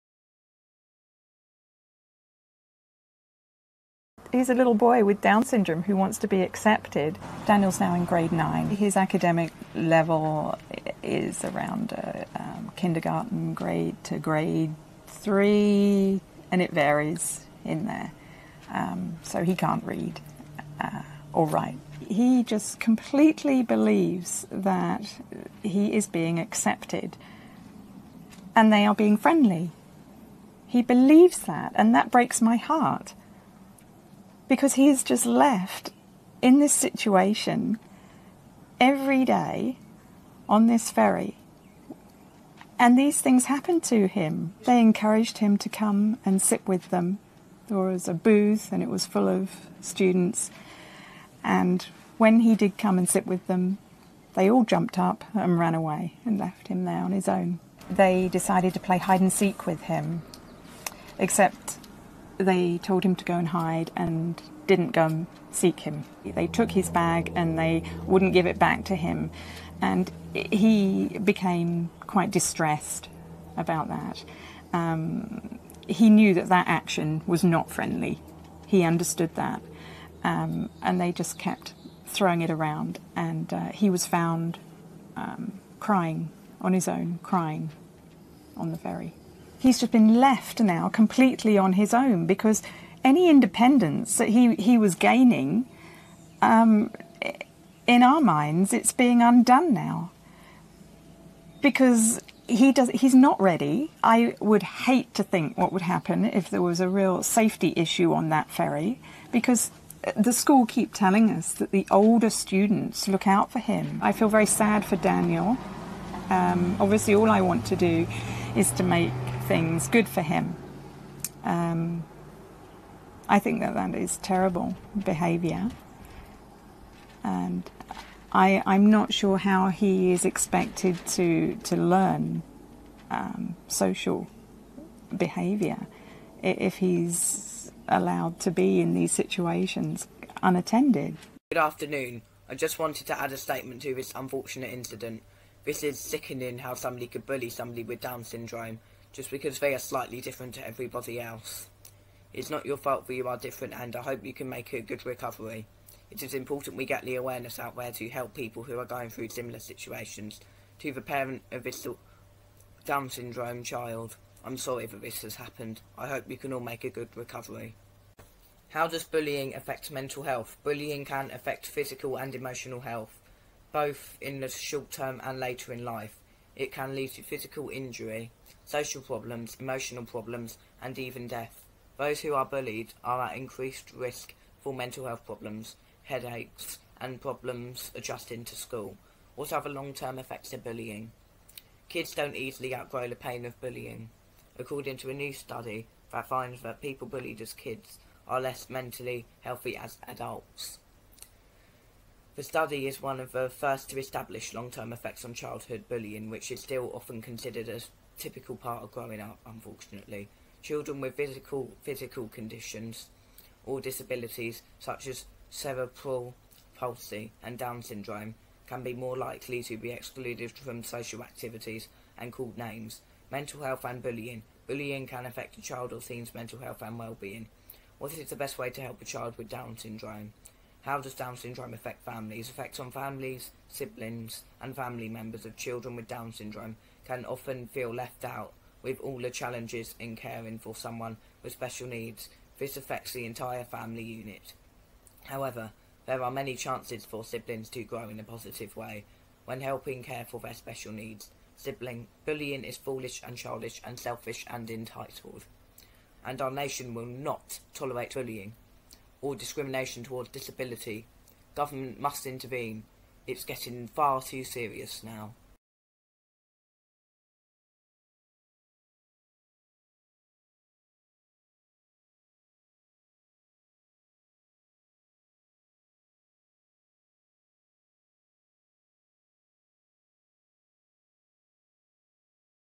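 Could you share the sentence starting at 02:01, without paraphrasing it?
Um, I think that that is terrible behaviour.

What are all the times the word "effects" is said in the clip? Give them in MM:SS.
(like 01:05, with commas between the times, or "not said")
03:10, 03:24, 03:52.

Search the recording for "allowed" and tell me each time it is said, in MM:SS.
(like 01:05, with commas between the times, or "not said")
02:17.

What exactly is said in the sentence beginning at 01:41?
Because he does, he's not ready.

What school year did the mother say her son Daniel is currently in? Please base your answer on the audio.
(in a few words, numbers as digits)
Grade 9.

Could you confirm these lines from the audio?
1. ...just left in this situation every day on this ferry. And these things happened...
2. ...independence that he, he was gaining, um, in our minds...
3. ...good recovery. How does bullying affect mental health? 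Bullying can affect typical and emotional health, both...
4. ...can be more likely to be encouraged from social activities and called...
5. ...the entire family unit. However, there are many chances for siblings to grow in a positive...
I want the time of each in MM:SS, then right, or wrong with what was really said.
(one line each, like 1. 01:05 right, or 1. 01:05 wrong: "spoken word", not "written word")
1. 00:35 right
2. 01:33 right
3. 02:46 wrong: "physical", not "typical"
4. 03:38 wrong: "excluded", not "encouraged"
5. 04:03 right.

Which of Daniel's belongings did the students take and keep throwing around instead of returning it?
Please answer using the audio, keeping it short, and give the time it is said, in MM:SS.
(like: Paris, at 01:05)
His bag, at 01:06.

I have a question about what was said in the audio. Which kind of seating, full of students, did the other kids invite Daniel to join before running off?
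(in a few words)
A booth.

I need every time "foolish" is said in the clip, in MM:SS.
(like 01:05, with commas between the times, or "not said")
04:12.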